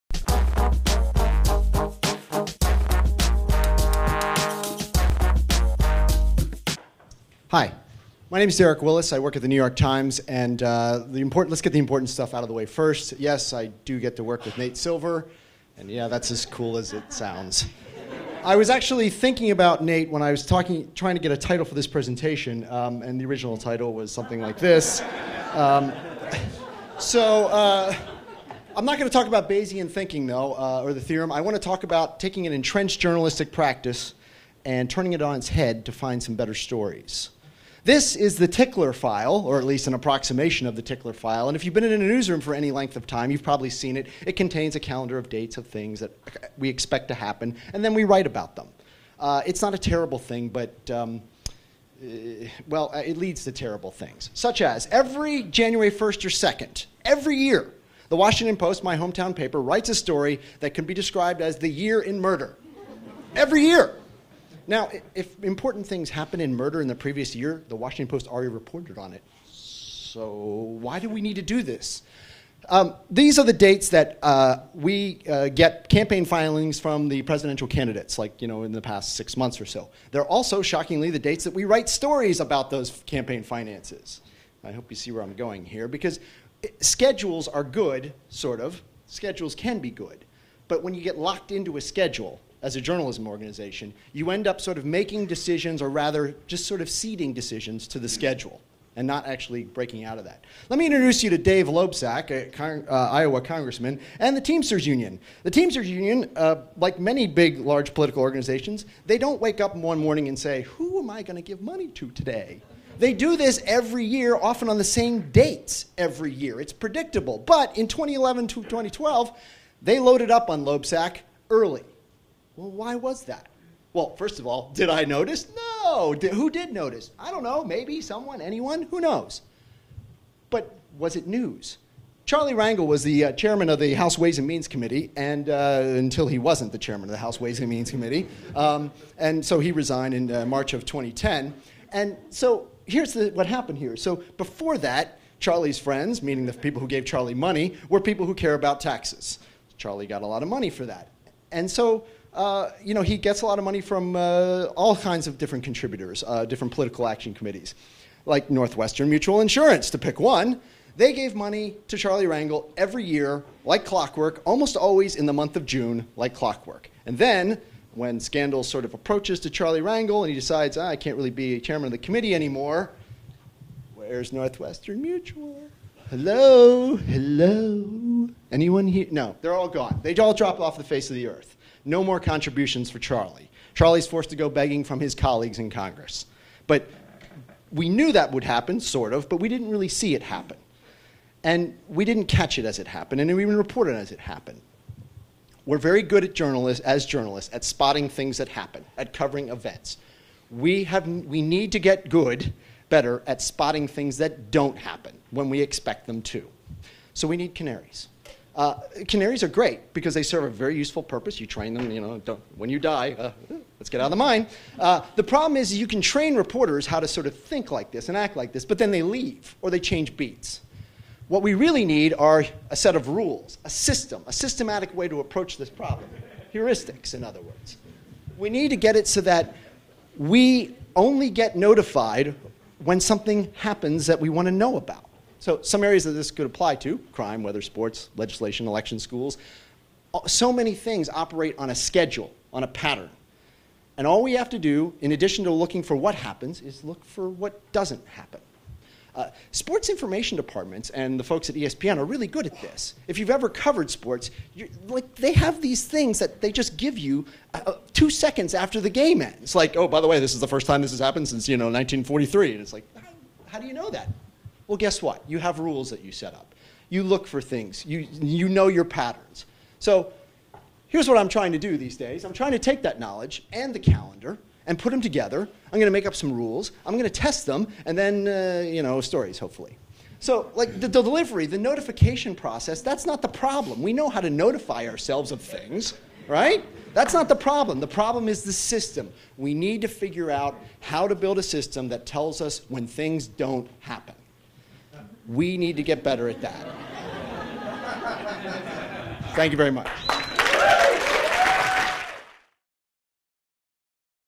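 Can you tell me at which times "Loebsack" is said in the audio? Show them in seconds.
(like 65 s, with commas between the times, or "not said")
101 s, 120 s.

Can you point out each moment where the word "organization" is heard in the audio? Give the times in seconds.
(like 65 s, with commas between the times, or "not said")
93 s, 108 s.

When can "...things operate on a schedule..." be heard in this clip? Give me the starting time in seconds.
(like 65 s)
240 s.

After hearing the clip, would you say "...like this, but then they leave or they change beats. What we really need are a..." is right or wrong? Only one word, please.
right.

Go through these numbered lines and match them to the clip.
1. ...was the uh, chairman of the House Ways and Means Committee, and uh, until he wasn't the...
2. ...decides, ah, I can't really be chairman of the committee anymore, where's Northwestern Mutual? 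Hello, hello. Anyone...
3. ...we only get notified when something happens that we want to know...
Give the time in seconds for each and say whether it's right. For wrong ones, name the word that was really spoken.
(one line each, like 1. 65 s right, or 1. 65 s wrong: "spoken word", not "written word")
1. 132 s right
2. 170 s right
3. 230 s right.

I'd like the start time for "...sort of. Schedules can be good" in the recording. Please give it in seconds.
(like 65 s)
88 s.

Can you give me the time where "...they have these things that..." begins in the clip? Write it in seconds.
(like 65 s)
255 s.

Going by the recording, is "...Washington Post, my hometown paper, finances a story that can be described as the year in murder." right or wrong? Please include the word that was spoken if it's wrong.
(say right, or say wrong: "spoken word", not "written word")
wrong: "writes", not "finances".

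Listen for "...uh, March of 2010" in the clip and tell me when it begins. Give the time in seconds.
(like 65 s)
140 s.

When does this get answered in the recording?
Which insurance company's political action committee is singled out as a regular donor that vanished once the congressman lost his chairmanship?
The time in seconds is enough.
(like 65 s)
158 s.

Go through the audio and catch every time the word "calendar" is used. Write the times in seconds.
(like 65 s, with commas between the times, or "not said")
44 s, 273 s.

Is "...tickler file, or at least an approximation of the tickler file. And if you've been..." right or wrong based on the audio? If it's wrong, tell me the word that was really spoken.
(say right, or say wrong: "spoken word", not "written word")
right.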